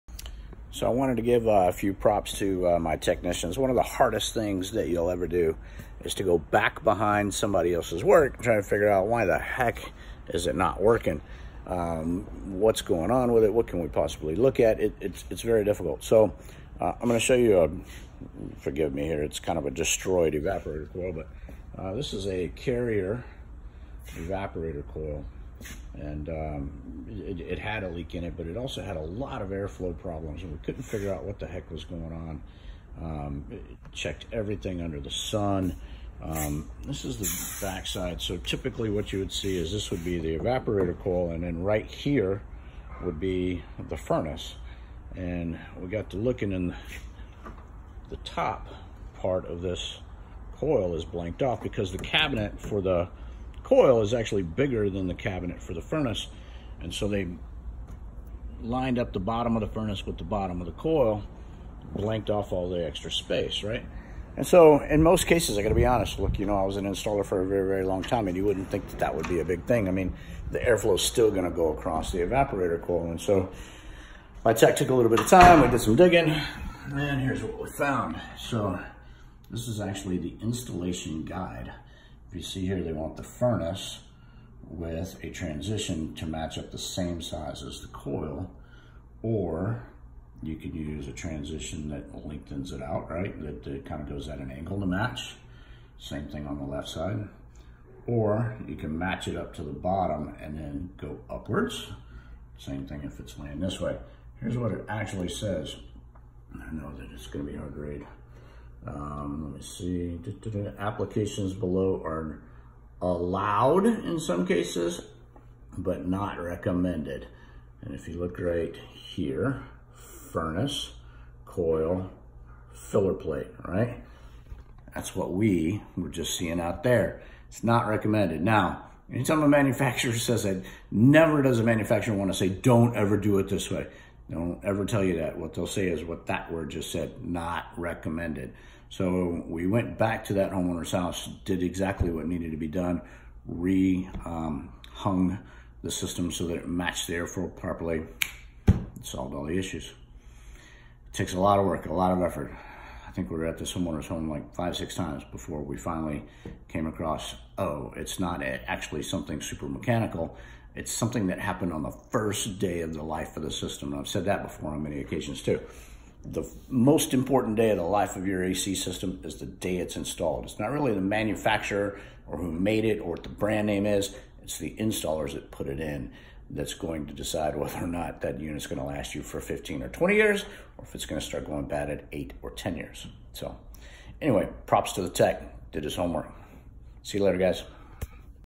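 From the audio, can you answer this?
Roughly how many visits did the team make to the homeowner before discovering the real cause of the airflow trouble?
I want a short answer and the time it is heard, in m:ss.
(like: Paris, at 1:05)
5 or 6, at 2:34.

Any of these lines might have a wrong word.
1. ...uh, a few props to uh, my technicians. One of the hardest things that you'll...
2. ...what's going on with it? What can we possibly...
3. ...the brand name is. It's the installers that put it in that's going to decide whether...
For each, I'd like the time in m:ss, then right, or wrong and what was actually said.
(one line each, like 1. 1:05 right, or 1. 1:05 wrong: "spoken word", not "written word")
1. 0:01 right
2. 0:12 right
3. 2:53 right.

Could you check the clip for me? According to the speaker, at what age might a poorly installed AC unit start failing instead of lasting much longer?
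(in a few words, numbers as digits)
8 or 10 years.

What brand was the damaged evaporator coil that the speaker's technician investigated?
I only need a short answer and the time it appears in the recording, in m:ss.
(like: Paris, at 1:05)
Carrier, at 0:22.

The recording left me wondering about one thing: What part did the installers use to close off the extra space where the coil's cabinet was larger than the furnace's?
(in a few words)
Filler plate.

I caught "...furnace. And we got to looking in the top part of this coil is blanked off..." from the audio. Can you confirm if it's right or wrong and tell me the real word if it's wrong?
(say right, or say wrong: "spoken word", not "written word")
right.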